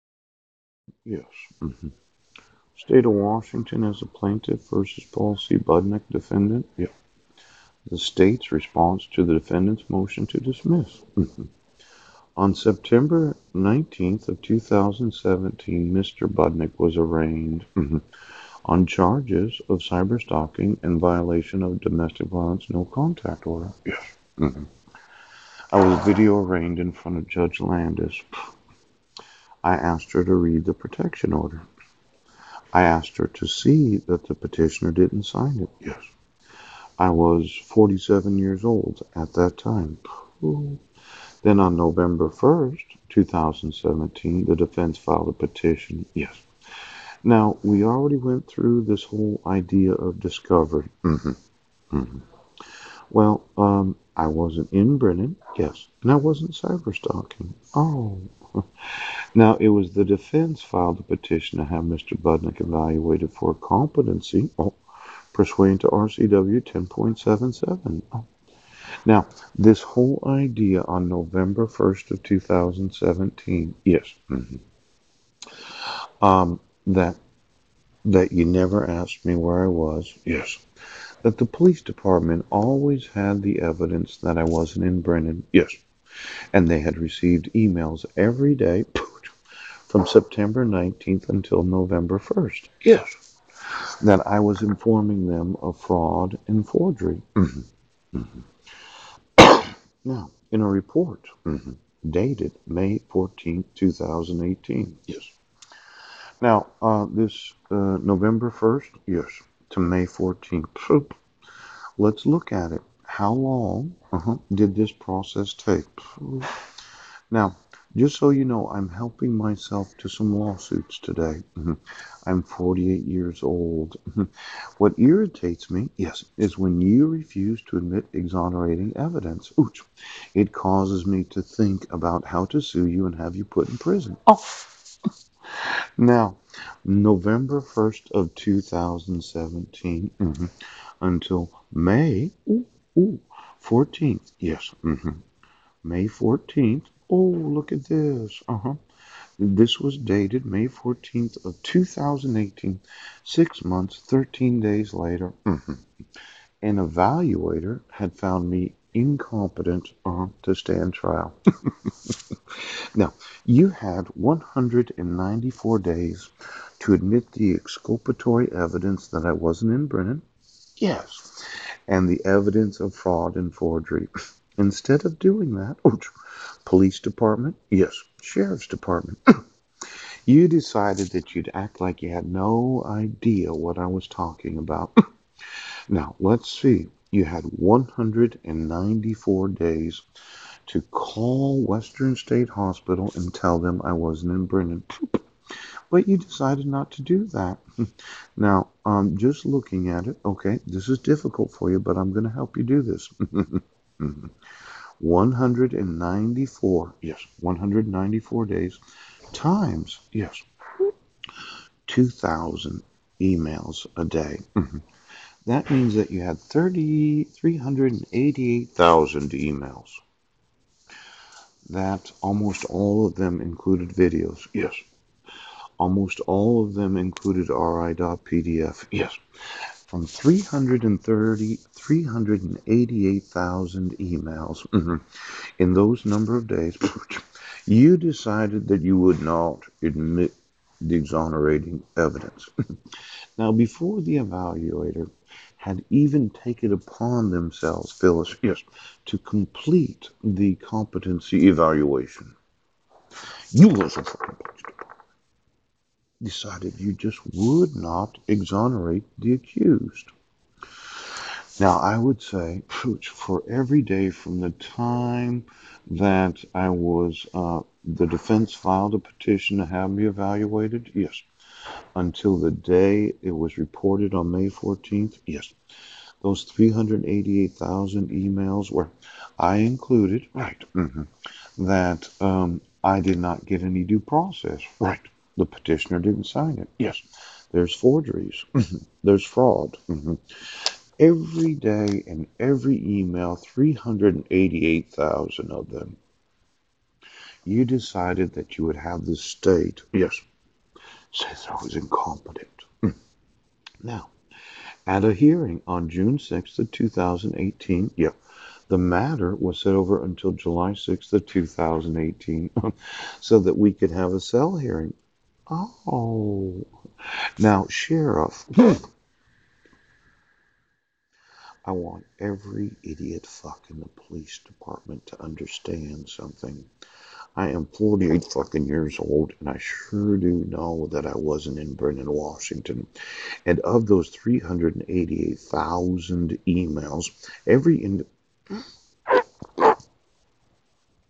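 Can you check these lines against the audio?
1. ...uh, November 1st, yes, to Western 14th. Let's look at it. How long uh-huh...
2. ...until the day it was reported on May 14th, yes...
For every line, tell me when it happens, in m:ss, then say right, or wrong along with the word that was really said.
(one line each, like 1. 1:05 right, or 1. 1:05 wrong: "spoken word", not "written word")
1. 1:47 wrong: "May", not "Western"
2. 4:31 right.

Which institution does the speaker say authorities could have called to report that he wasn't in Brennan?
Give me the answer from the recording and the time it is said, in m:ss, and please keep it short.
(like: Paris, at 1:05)
Western State Hospital, at 3:11.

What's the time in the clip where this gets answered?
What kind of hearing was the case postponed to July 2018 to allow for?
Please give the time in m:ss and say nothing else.
5:14.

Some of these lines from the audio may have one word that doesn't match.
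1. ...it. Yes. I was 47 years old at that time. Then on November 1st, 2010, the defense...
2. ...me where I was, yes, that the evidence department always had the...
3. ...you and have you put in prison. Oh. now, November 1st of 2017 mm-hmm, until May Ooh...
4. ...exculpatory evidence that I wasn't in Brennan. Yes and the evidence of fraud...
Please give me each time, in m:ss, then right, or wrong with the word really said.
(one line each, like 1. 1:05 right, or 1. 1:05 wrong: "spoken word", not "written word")
1. 0:35 wrong: "2017", not "2010"
2. 1:19 wrong: "police", not "evidence"
3. 2:12 right
4. 2:47 right.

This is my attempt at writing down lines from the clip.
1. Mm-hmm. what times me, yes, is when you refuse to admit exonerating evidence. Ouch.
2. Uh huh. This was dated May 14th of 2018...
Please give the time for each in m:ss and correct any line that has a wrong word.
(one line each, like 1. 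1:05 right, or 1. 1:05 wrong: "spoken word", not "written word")
1. 2:04 wrong: "irritates", not "times"
2. 2:28 right.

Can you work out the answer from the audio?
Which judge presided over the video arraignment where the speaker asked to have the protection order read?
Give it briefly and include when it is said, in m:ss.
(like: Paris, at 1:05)
Judge Landis, at 0:27.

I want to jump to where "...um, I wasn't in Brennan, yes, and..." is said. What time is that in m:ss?
0:53.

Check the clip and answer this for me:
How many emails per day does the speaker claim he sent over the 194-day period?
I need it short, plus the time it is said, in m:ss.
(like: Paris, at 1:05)
2,000, at 3:31.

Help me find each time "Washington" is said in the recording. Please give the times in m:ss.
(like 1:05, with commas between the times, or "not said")
0:03, 5:32.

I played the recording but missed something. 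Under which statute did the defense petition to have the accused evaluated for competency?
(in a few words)
RCW 10.77.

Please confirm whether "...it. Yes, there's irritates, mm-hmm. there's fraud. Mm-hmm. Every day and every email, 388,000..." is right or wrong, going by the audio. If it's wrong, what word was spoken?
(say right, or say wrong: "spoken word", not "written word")
wrong: "forgeries", not "irritates".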